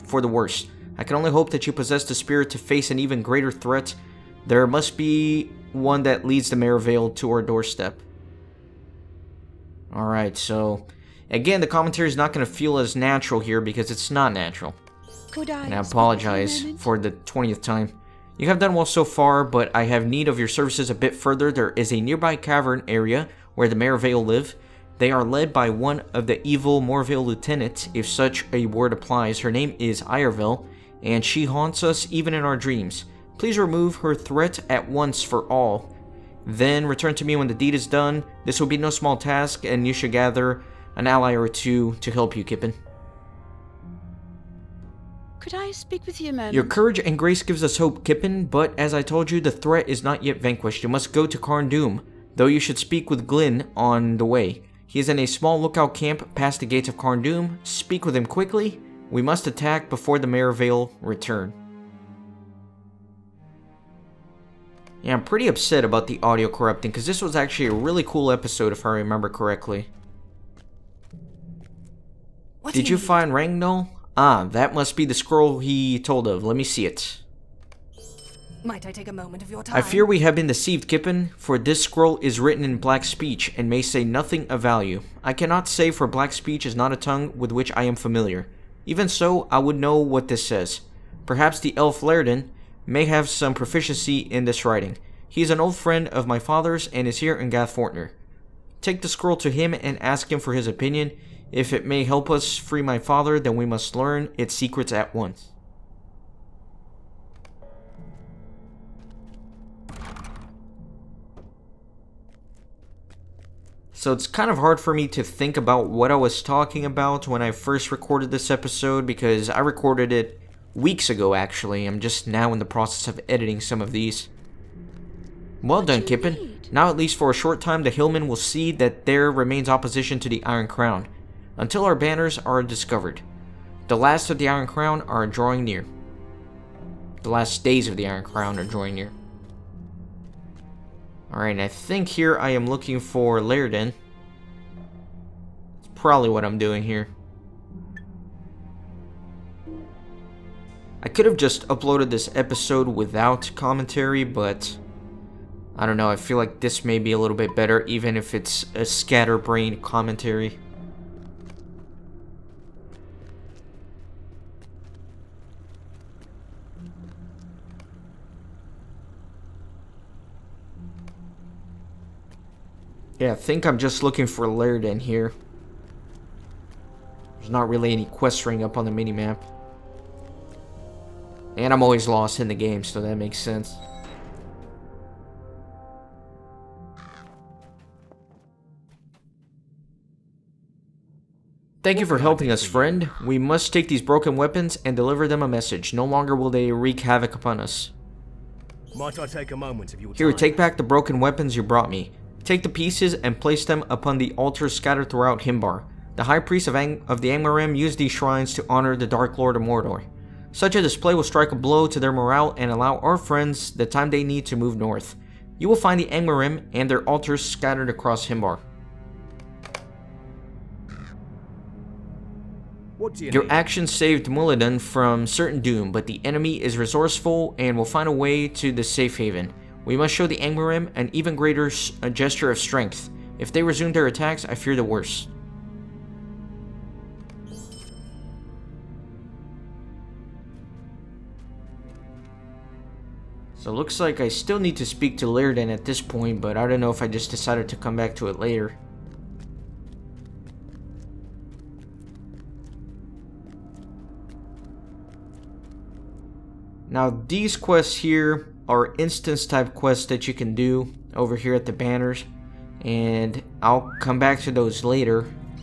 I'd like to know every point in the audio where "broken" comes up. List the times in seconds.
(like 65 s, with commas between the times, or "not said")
194 s, 200 s.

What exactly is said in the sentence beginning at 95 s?
He is an old friend of my father's and is here in Gath Forthnir.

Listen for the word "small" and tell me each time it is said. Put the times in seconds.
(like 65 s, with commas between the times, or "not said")
38 s, 55 s.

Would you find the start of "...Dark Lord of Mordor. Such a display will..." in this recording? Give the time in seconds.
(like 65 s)
209 s.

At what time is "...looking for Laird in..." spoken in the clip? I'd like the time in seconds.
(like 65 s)
174 s.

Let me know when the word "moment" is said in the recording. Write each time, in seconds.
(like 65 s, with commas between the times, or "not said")
79 s, 199 s.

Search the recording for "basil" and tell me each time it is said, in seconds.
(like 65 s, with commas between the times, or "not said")
not said.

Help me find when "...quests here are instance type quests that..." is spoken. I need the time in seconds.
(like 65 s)
257 s.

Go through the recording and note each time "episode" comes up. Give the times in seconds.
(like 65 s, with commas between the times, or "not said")
68 s, 118 s, 152 s.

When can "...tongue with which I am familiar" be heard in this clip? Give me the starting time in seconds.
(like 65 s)
86 s.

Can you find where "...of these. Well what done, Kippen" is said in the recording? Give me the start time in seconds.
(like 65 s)
123 s.